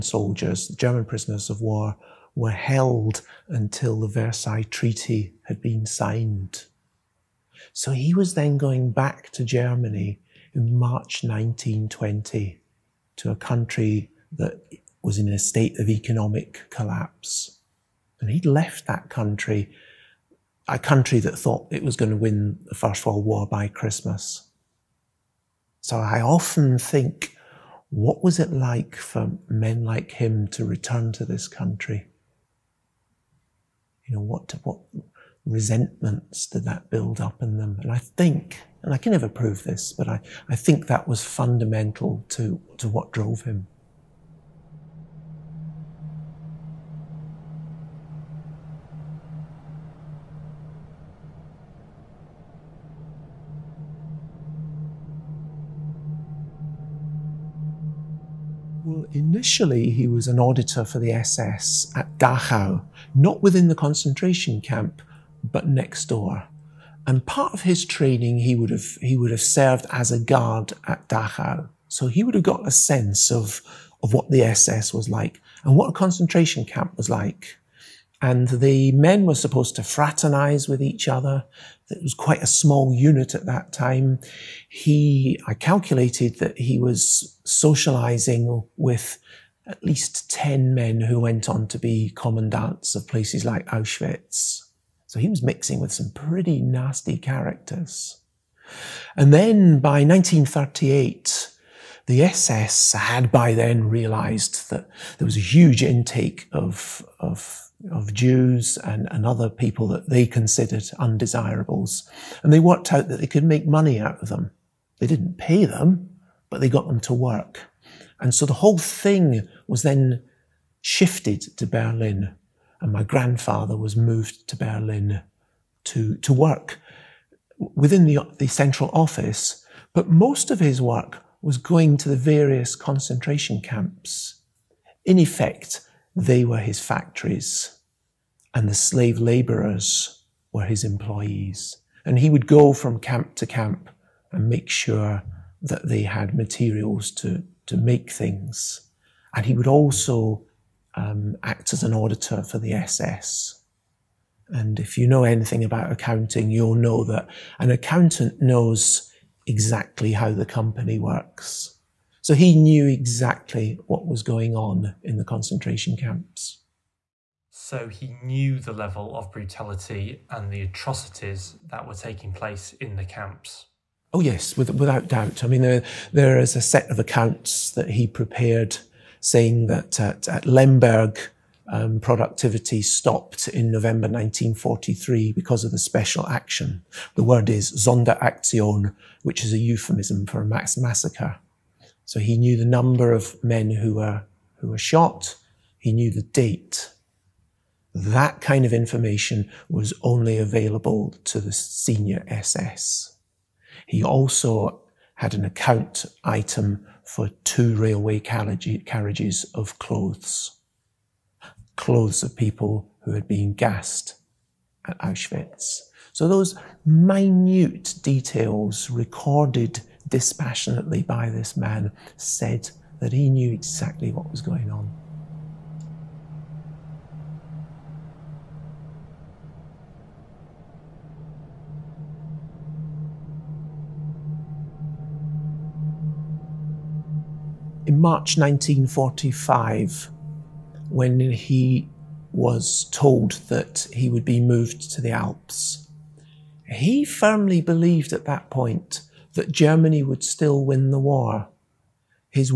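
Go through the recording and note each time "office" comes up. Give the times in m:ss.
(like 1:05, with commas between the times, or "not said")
2:08.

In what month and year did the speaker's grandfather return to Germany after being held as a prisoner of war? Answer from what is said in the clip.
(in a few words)
March 1920.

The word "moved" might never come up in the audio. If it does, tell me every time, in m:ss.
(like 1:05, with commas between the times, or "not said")
2:03, 4:04.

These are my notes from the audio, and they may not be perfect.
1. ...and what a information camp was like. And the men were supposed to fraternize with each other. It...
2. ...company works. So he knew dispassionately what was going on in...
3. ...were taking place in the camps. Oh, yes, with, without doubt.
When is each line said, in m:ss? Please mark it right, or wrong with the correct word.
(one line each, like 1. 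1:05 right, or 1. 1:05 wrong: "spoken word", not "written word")
1. 1:15 wrong: "concentration", not "information"
2. 2:40 wrong: "exactly", not "dispassionately"
3. 2:51 right.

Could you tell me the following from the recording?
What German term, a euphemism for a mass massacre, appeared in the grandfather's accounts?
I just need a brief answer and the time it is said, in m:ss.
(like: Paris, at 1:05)
Sonderaktion, at 3:07.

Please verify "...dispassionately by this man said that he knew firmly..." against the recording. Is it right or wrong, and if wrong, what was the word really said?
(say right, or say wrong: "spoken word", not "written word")
wrong: "exactly", not "firmly".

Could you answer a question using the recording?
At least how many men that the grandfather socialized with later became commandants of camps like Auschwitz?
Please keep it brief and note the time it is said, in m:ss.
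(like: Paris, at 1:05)
10, at 1:30.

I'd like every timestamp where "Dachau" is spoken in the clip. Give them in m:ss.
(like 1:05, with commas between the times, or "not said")
1:02, 1:11.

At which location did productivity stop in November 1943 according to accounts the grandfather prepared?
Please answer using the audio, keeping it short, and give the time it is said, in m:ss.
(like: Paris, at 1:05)
Lemberg, at 3:00.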